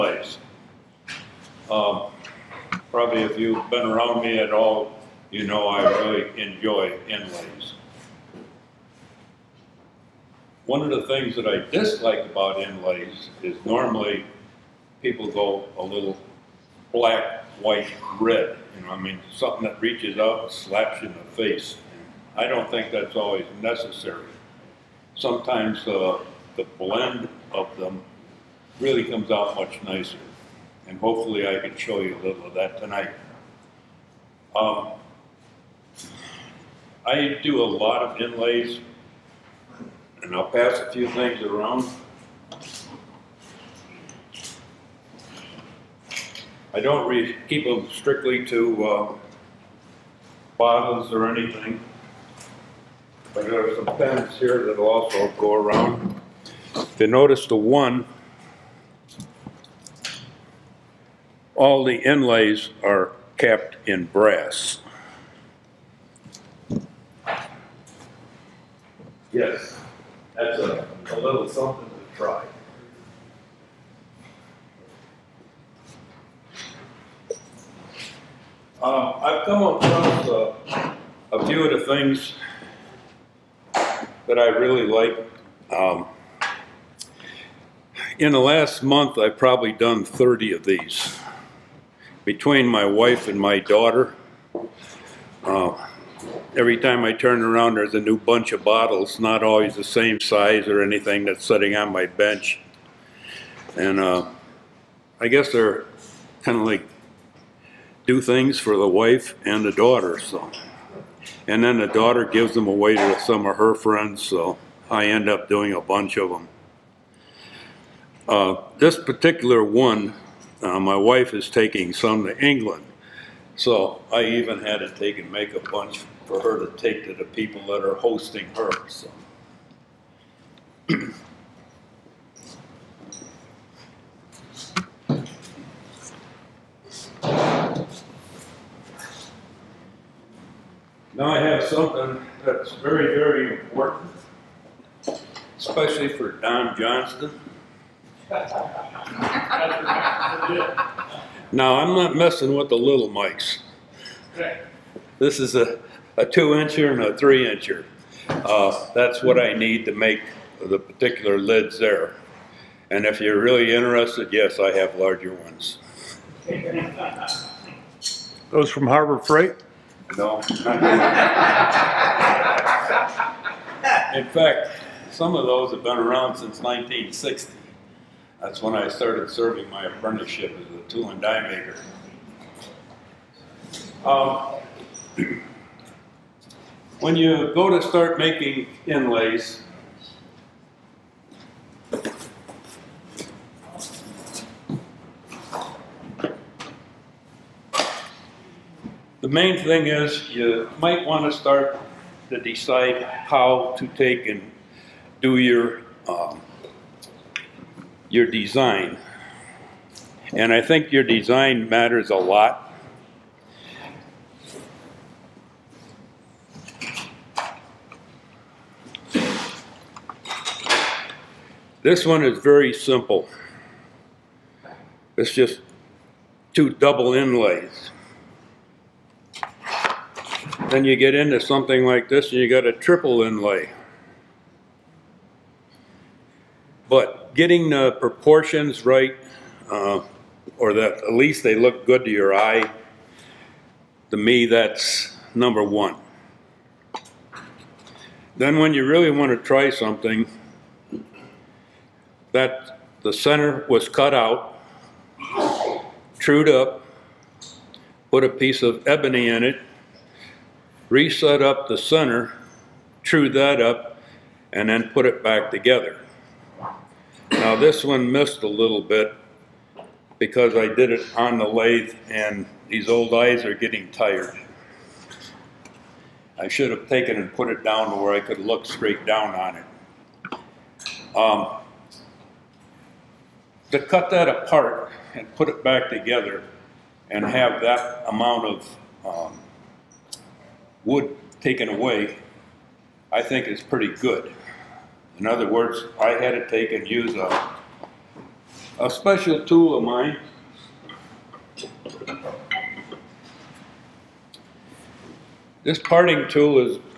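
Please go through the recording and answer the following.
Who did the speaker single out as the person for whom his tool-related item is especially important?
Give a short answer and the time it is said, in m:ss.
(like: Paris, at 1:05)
Don Johnston, at 2:26.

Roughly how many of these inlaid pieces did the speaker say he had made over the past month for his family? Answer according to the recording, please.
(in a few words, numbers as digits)
30.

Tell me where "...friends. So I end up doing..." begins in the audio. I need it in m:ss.
1:53.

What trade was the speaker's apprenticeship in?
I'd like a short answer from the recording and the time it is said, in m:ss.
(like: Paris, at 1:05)
tool and die maker, at 3:00.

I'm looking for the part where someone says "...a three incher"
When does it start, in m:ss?
2:37.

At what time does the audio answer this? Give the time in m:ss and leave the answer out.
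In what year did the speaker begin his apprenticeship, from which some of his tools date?
2:56.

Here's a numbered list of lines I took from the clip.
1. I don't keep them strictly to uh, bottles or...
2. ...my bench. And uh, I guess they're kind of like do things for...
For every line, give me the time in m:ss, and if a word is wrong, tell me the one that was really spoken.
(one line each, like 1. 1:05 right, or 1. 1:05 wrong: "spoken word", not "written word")
1. 0:46 right
2. 1:41 right.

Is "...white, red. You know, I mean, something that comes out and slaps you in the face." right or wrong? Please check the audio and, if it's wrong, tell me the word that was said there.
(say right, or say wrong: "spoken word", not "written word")
wrong: "reaches", not "comes".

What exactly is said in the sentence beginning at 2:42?
And if you're really interested, yes, I have larger ones.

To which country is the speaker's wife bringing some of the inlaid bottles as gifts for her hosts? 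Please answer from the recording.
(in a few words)
England.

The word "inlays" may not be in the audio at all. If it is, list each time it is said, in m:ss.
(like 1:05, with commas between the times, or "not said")
0:07, 0:12, 0:38, 1:01, 3:08, 3:47, 3:53.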